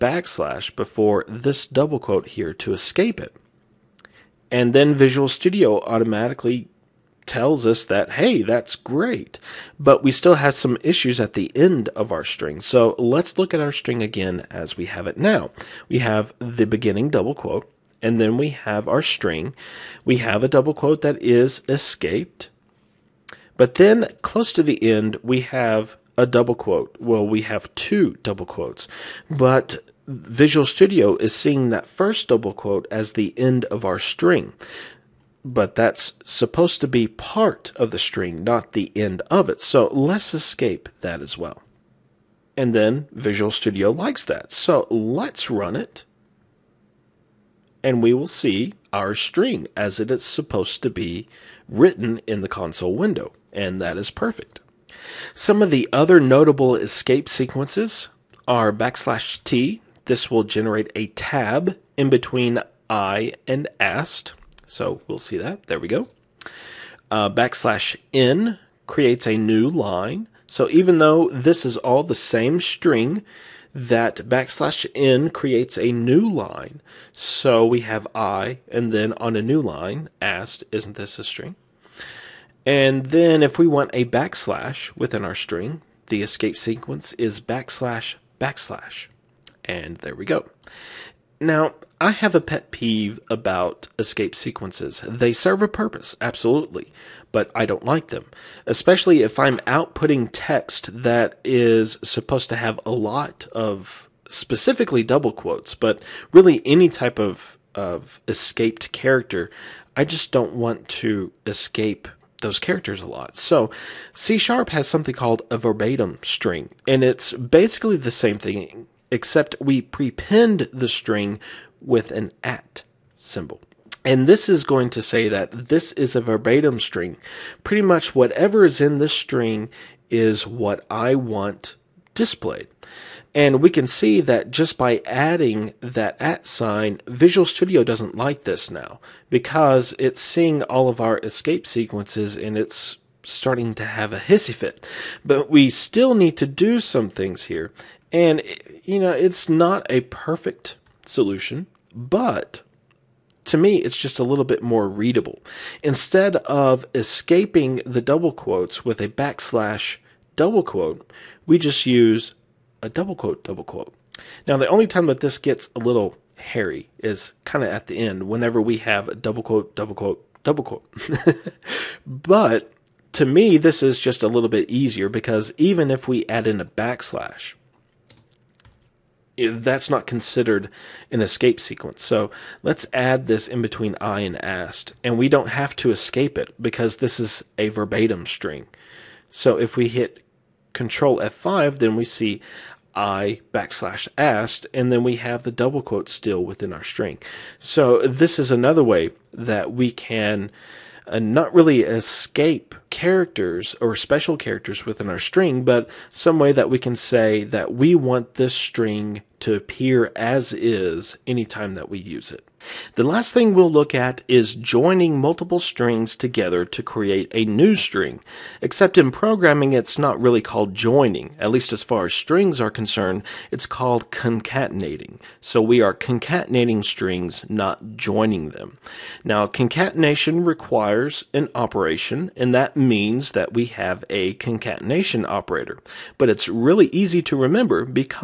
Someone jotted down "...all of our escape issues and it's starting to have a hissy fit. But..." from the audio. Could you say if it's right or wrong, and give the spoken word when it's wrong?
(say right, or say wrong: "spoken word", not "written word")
wrong: "sequences", not "issues".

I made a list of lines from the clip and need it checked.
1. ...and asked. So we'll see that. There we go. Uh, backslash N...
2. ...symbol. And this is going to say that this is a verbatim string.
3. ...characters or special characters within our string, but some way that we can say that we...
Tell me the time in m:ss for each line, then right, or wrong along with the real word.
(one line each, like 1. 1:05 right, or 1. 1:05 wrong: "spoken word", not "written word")
1. 1:03 right
2. 2:03 right
3. 3:22 right.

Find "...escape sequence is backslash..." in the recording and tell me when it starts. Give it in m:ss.
1:26.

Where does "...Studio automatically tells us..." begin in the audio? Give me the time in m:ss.
0:05.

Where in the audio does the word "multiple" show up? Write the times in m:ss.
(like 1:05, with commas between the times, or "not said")
3:35.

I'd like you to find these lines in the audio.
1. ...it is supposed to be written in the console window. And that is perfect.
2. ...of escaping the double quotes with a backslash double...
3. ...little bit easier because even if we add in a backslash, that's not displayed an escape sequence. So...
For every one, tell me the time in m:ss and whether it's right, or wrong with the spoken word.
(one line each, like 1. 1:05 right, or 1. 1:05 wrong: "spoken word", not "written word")
1. 0:49 right
2. 2:36 right
3. 2:54 wrong: "considered", not "displayed".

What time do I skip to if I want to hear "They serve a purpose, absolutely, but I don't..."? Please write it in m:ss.
1:35.